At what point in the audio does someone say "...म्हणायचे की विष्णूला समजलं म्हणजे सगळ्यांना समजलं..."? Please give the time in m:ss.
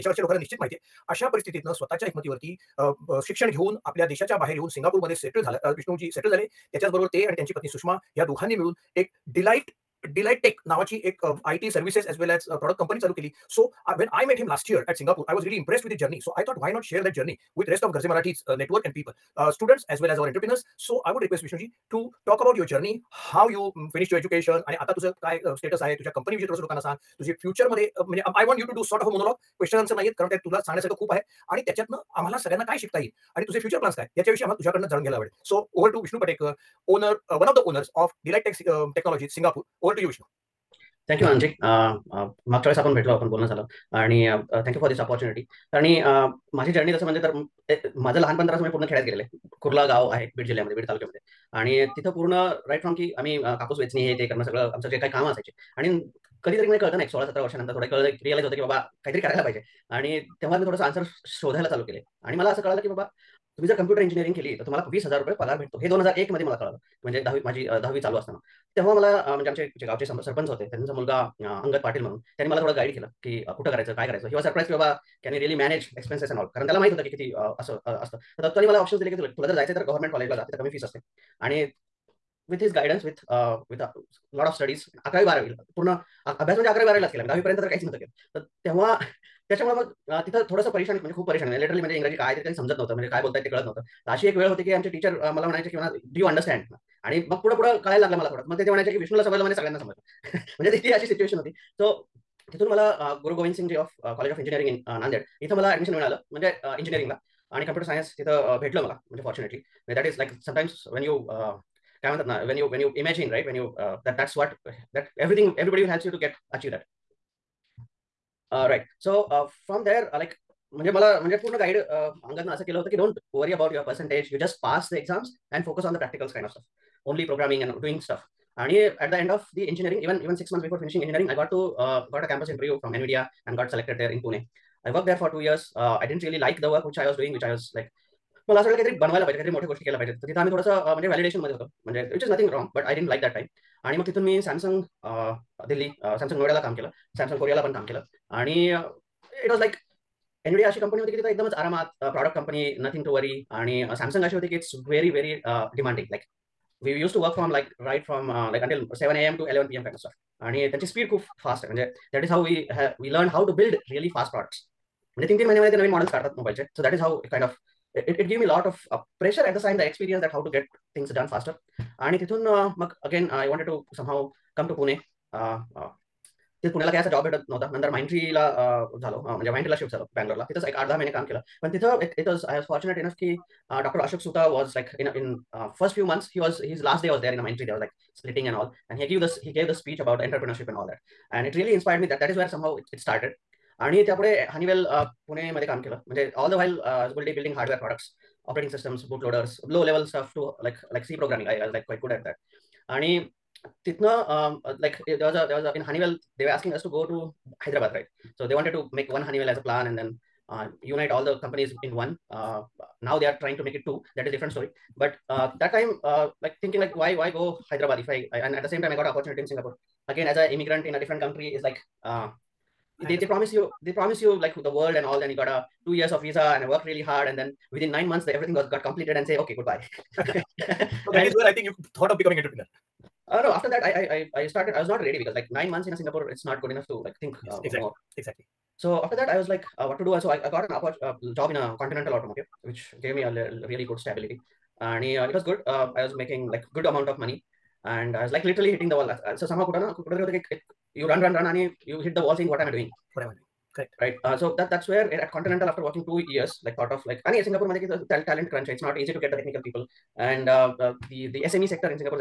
1:38.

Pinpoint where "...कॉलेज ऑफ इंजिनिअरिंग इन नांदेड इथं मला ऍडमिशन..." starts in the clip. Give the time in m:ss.
1:44.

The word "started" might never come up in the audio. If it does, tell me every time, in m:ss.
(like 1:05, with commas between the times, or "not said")
3:13, 3:54.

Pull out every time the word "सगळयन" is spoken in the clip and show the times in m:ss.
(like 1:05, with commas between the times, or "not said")
0:32, 1:39.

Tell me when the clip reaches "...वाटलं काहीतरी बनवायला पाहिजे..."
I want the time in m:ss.
2:18.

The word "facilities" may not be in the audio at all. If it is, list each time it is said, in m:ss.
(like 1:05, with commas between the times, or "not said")
not said.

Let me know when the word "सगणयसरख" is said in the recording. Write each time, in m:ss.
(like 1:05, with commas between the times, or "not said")
0:30.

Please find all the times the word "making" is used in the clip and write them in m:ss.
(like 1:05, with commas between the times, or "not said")
4:06.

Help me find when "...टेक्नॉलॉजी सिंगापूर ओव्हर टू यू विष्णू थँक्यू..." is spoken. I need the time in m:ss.
0:38.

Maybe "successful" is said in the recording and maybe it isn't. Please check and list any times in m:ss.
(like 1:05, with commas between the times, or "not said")
not said.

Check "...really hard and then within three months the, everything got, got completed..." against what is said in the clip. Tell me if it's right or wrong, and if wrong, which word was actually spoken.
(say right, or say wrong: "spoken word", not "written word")
wrong: "nine", not "three".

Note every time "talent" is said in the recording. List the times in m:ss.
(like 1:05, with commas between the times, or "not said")
4:18.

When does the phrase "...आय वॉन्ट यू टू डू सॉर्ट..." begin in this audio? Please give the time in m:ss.
0:28.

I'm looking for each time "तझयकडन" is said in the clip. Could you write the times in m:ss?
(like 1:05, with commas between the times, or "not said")
0:34.